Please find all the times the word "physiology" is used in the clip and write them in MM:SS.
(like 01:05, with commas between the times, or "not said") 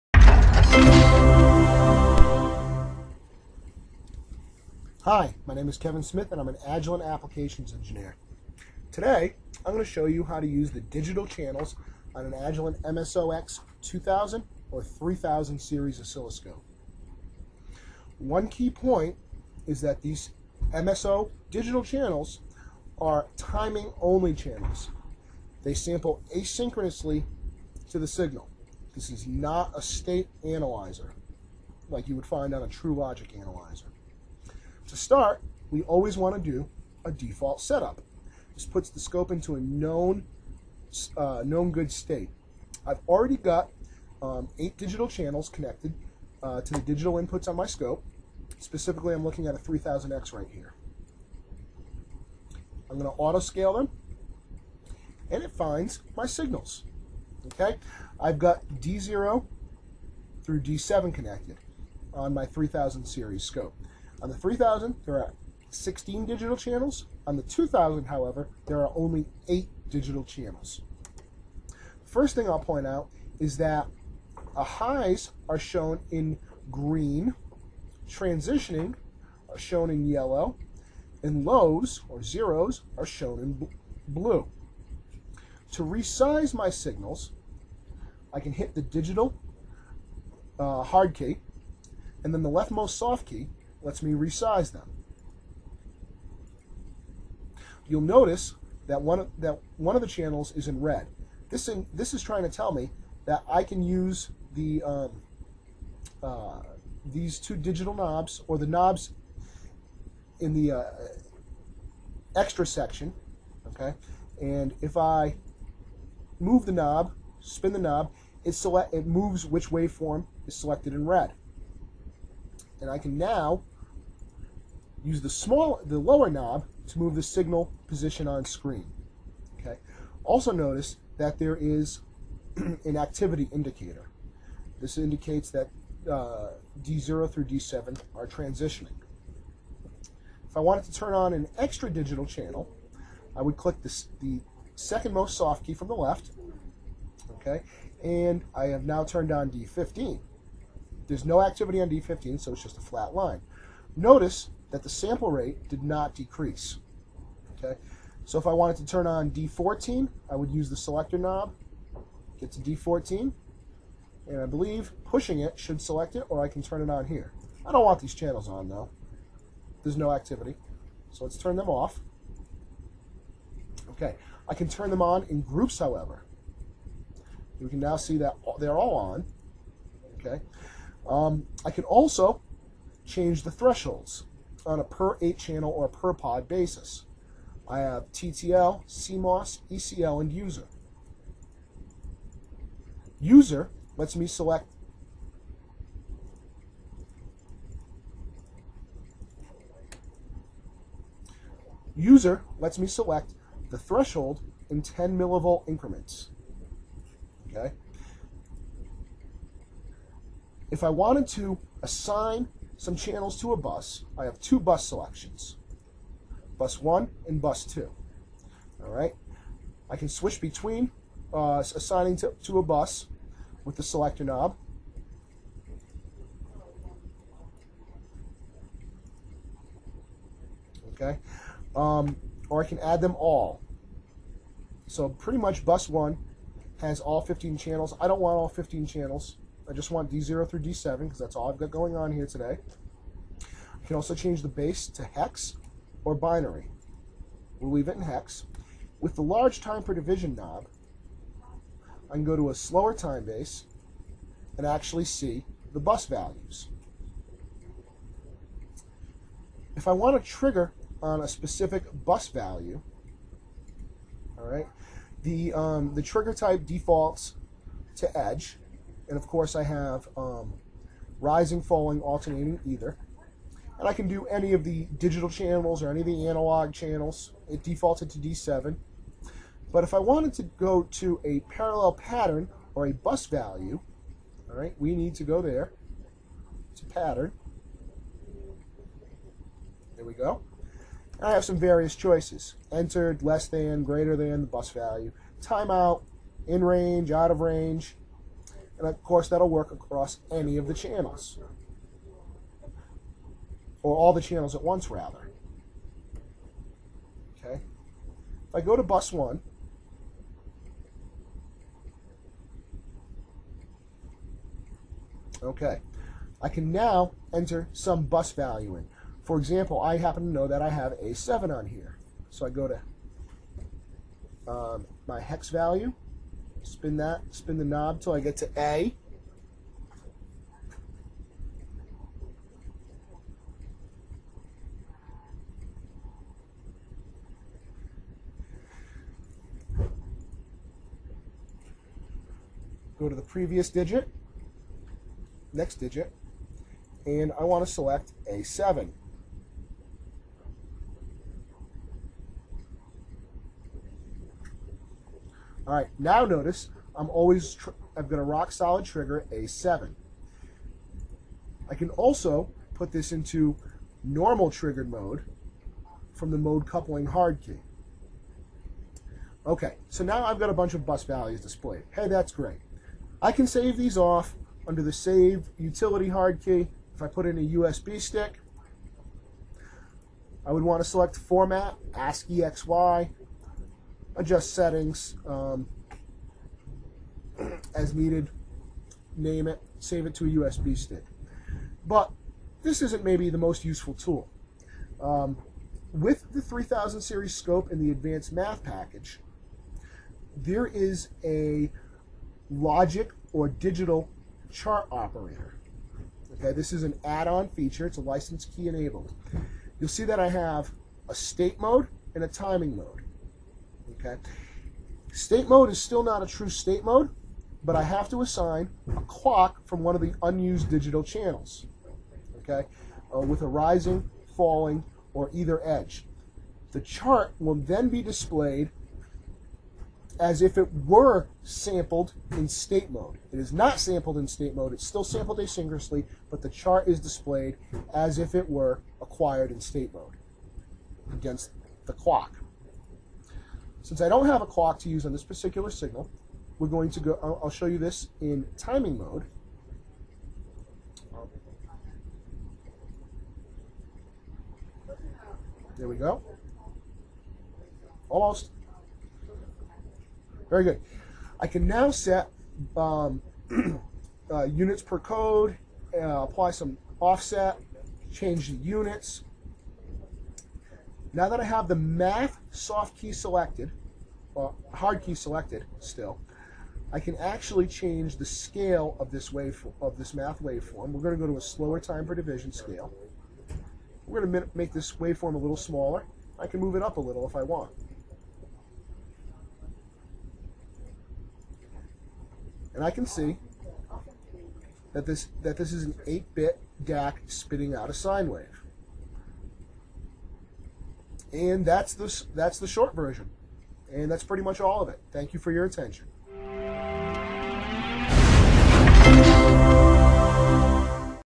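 not said.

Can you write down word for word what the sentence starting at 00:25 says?
They sample asynchronously to the signal.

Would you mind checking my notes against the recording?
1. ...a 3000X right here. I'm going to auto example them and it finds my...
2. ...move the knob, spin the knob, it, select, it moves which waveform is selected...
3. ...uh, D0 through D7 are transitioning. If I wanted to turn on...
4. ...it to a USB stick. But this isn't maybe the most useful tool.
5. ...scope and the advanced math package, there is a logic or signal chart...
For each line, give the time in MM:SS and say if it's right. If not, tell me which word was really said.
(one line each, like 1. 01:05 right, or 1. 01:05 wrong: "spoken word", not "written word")
1. 00:49 wrong: "scale", not "example"
2. 01:56 right
3. 02:16 right
4. 06:30 right
5. 06:37 wrong: "digital", not "signal".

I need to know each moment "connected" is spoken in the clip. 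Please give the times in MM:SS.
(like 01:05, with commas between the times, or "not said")
00:45, 01:01.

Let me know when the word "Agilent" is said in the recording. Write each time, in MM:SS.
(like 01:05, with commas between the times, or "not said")
00:06, 00:12.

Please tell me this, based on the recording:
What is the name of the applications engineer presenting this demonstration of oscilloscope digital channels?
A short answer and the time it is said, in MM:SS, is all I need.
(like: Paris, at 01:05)
Kevin Smith, at 00:05.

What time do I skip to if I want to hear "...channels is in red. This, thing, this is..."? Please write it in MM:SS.
01:40.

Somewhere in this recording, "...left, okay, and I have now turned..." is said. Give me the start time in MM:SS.
02:25.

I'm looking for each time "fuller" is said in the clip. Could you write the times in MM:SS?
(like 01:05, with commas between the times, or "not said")
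not said.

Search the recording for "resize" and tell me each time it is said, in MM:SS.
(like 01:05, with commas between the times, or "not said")
01:25, 01:34.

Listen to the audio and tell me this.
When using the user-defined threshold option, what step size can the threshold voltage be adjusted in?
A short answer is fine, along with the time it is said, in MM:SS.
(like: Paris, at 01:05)
10 millivolts, at 03:24.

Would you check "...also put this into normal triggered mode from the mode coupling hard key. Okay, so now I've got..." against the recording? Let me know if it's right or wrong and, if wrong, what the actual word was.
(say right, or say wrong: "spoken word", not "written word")
right.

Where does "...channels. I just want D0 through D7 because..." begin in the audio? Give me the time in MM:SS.
03:58.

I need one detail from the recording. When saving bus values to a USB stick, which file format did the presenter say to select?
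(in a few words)
ASCII XY.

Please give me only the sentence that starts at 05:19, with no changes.
For example, I happen to know that I have a 7 on here.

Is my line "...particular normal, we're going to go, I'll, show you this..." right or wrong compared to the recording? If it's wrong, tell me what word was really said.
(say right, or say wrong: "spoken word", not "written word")
wrong: "signal", not "normal".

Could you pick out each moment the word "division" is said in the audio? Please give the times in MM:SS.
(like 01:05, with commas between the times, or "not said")
04:09, 08:02.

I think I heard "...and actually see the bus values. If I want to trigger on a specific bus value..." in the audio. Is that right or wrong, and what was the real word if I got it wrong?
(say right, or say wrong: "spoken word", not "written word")
right.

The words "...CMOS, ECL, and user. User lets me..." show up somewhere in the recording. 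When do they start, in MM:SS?
03:08.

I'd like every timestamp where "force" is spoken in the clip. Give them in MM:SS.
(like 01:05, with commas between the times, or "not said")
not said.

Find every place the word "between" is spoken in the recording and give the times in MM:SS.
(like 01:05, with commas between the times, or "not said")
03:40.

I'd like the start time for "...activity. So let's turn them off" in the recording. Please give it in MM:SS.
02:50.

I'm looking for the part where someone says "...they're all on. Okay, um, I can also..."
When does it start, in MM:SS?
02:58.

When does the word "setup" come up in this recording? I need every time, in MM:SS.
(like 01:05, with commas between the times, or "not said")
00:37.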